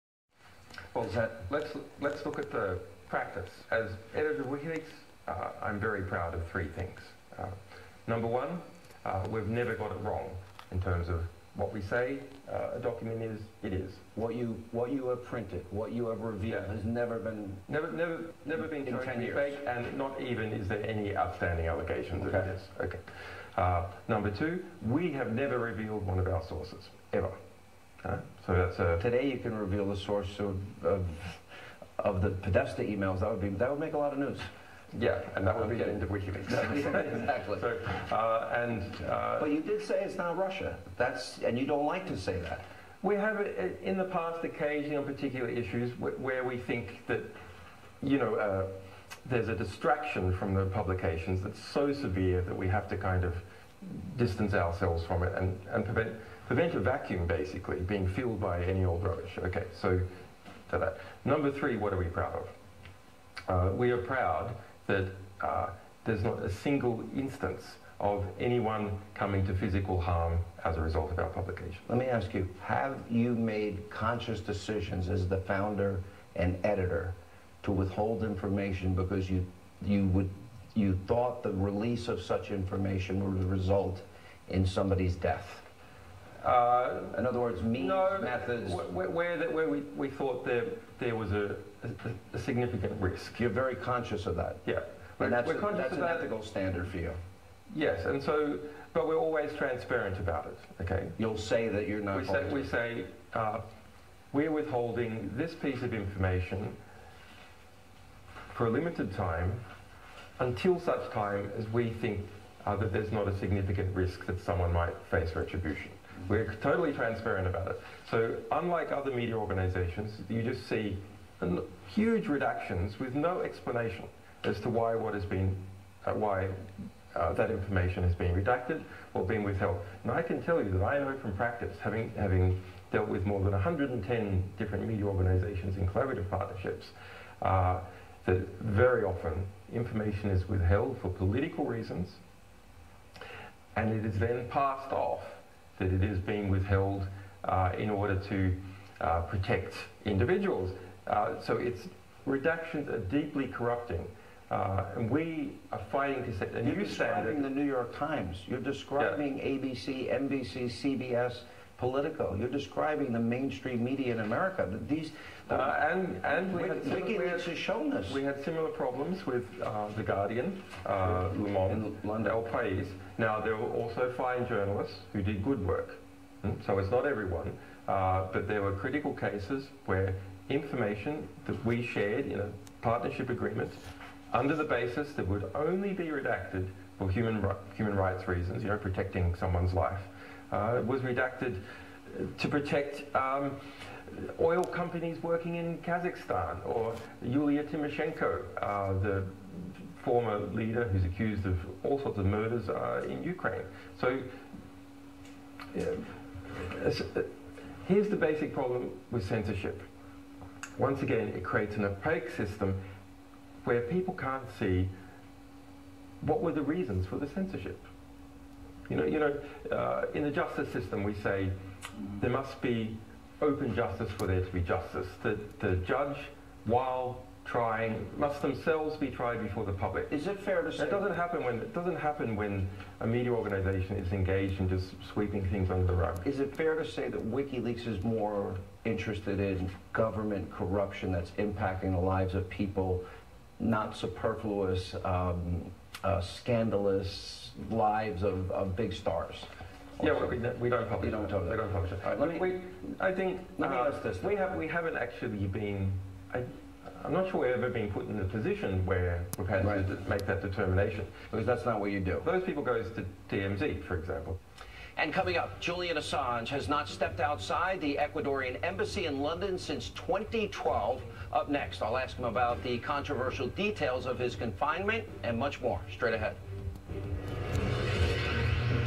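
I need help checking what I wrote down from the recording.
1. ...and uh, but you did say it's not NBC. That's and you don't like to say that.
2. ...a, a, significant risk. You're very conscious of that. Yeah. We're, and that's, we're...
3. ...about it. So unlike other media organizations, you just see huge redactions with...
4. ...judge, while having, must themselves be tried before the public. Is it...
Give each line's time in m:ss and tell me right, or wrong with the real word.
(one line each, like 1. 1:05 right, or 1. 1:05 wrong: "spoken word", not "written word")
1. 0:38 wrong: "Russia", not "NBC"
2. 1:31 right
3. 1:57 right
4. 3:45 wrong: "trying", not "having".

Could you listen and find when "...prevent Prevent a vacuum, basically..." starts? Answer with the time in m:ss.
0:55.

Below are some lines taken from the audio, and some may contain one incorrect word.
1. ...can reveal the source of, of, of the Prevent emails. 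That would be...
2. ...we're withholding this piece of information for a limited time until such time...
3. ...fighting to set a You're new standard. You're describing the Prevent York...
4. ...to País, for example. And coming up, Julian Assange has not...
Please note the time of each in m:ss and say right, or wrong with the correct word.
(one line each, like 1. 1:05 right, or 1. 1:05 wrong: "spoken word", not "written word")
1. 0:29 wrong: "Podesta", not "Prevent"
2. 1:44 right
3. 2:35 wrong: "New", not "Prevent"
4. 4:22 wrong: "TMZ", not "País".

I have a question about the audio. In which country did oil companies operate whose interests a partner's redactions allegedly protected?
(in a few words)
Kazakhstan.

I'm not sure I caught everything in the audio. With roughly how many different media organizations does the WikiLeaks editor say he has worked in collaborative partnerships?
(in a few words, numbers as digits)
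more than 110.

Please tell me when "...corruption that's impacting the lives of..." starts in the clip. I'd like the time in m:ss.
4:00.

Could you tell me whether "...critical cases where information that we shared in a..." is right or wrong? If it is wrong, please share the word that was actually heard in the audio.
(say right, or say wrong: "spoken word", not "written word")
right.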